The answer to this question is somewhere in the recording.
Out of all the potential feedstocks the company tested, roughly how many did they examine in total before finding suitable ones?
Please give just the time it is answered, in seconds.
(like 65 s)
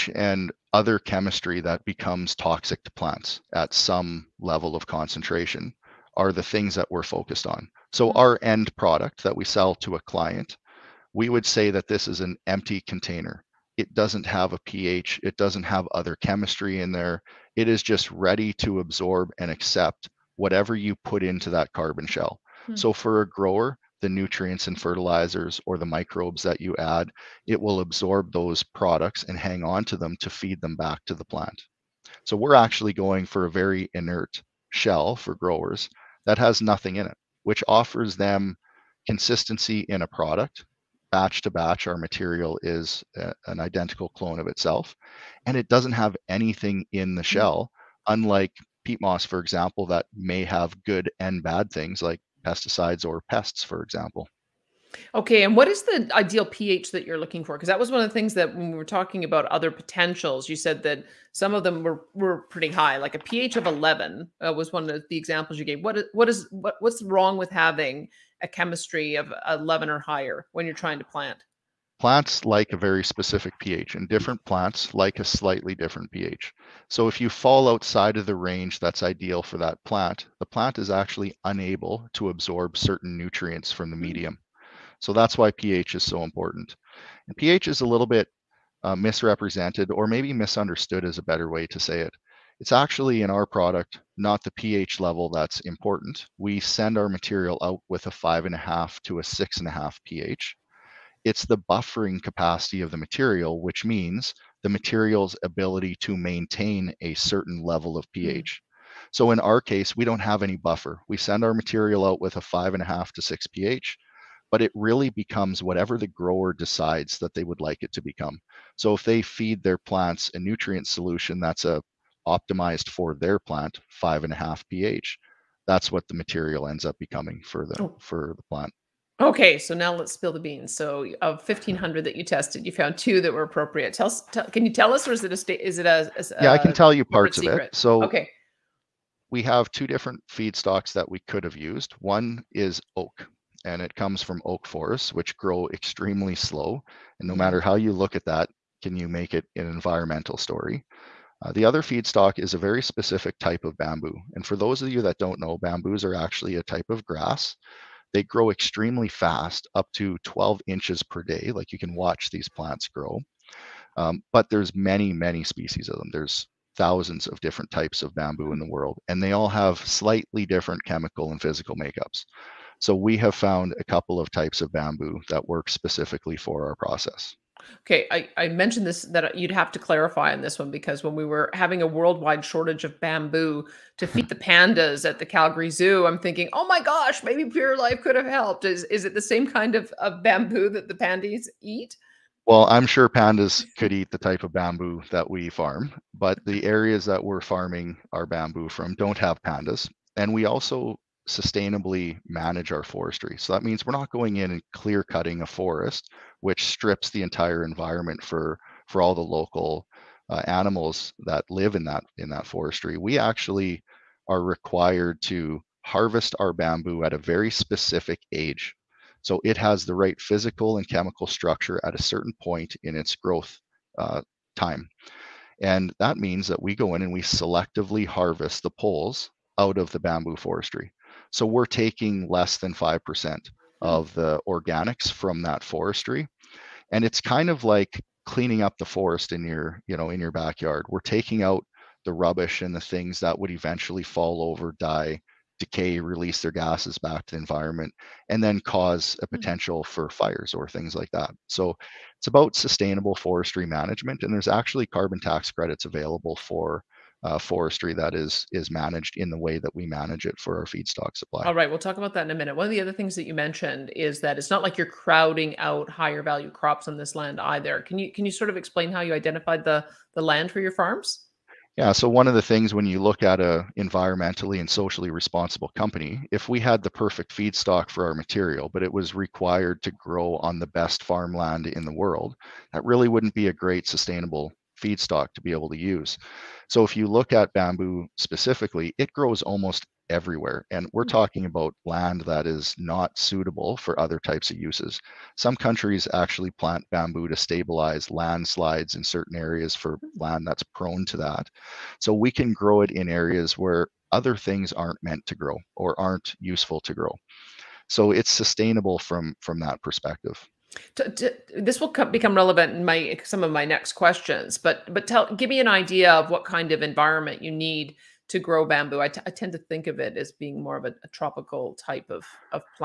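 131 s.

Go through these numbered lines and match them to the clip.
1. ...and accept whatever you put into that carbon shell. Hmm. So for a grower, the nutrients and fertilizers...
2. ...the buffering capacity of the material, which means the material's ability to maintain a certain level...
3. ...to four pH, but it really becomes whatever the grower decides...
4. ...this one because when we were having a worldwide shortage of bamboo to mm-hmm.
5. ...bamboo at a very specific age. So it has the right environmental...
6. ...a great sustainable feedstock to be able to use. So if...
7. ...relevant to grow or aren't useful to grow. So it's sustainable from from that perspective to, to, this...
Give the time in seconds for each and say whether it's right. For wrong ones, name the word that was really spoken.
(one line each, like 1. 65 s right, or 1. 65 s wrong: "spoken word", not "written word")
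1. 19 s right
2. 101 s right
3. 113 s wrong: "six", not "four"
4. 180 s right
5. 216 s wrong: "physical", not "environmental"
6. 283 s right
7. 305 s wrong: "meant", not "relevant".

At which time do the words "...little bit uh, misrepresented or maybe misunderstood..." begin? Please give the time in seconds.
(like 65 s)
87 s.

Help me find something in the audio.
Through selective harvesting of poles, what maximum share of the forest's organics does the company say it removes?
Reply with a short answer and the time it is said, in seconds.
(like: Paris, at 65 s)
Less than 5%, at 232 s.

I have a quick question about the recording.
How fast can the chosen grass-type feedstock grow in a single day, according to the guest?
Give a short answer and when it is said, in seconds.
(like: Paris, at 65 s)
12 inches, at 160 s.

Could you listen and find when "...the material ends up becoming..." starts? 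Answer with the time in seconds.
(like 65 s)
126 s.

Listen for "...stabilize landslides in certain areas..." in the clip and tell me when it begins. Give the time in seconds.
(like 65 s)
297 s.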